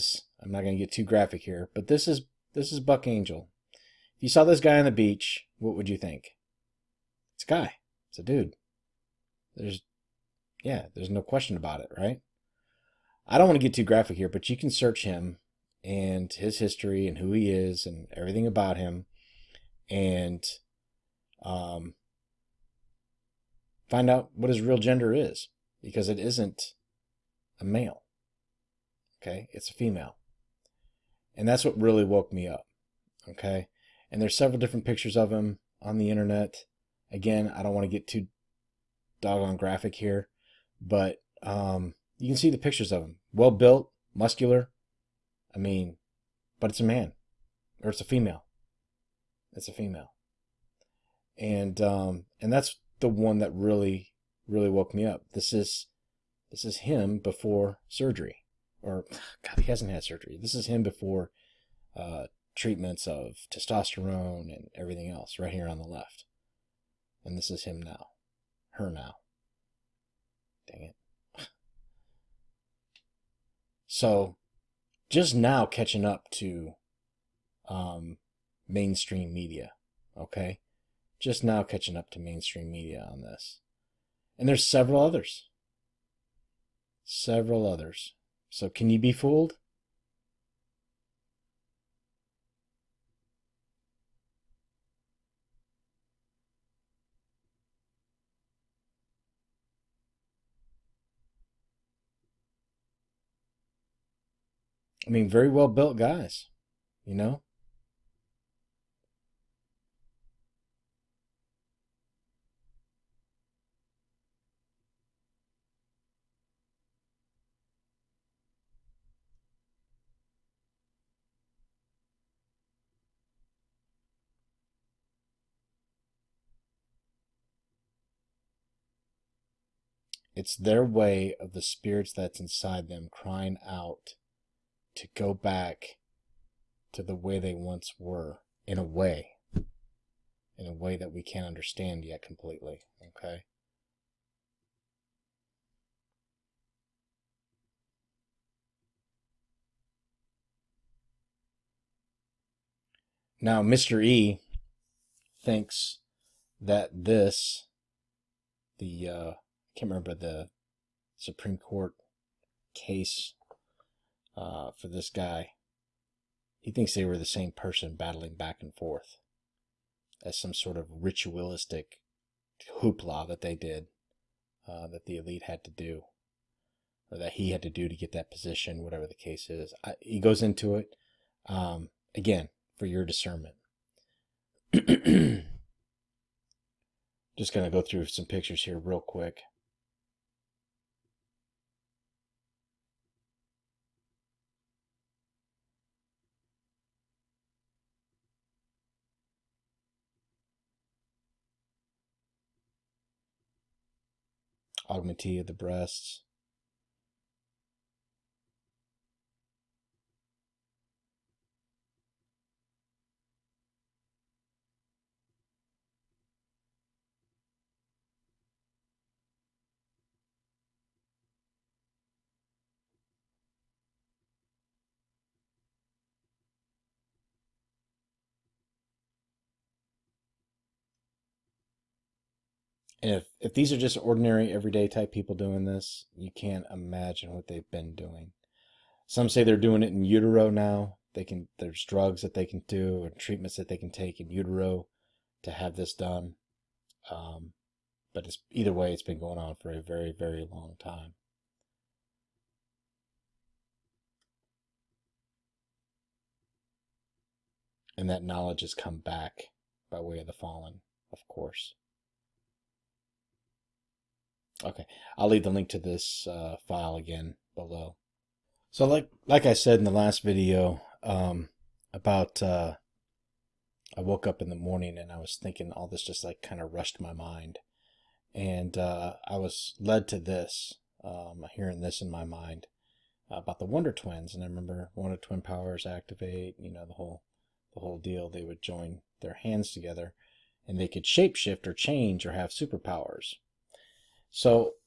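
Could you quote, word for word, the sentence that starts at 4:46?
You know the whole the whole deal.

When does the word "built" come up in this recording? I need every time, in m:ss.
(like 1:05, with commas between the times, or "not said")
0:43, 1:45.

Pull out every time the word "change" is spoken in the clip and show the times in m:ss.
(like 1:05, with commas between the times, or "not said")
4:51.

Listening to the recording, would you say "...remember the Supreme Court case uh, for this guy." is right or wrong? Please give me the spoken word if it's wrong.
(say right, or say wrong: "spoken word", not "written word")
right.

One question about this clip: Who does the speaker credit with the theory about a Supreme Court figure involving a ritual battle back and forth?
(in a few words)
Mr. E.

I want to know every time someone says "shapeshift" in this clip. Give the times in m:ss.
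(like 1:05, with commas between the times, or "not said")
4:51.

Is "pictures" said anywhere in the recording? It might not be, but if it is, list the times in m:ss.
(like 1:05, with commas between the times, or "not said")
0:34, 0:42, 3:08.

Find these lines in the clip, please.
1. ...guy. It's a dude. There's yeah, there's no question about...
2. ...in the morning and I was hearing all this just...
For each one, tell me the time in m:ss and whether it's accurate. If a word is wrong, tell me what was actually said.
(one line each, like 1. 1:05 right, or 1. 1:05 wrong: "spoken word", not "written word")
1. 0:07 right
2. 4:34 wrong: "thinking", not "hearing".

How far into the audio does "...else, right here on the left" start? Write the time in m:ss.
1:05.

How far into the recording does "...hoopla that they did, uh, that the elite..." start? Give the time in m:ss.
2:52.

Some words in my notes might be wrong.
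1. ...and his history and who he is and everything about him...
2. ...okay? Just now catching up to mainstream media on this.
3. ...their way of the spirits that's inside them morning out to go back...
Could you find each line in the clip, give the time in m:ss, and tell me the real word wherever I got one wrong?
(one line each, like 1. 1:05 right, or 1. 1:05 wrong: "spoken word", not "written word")
1. 0:15 right
2. 1:20 right
3. 2:10 wrong: "crying", not "morning".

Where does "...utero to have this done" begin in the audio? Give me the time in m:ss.
4:04.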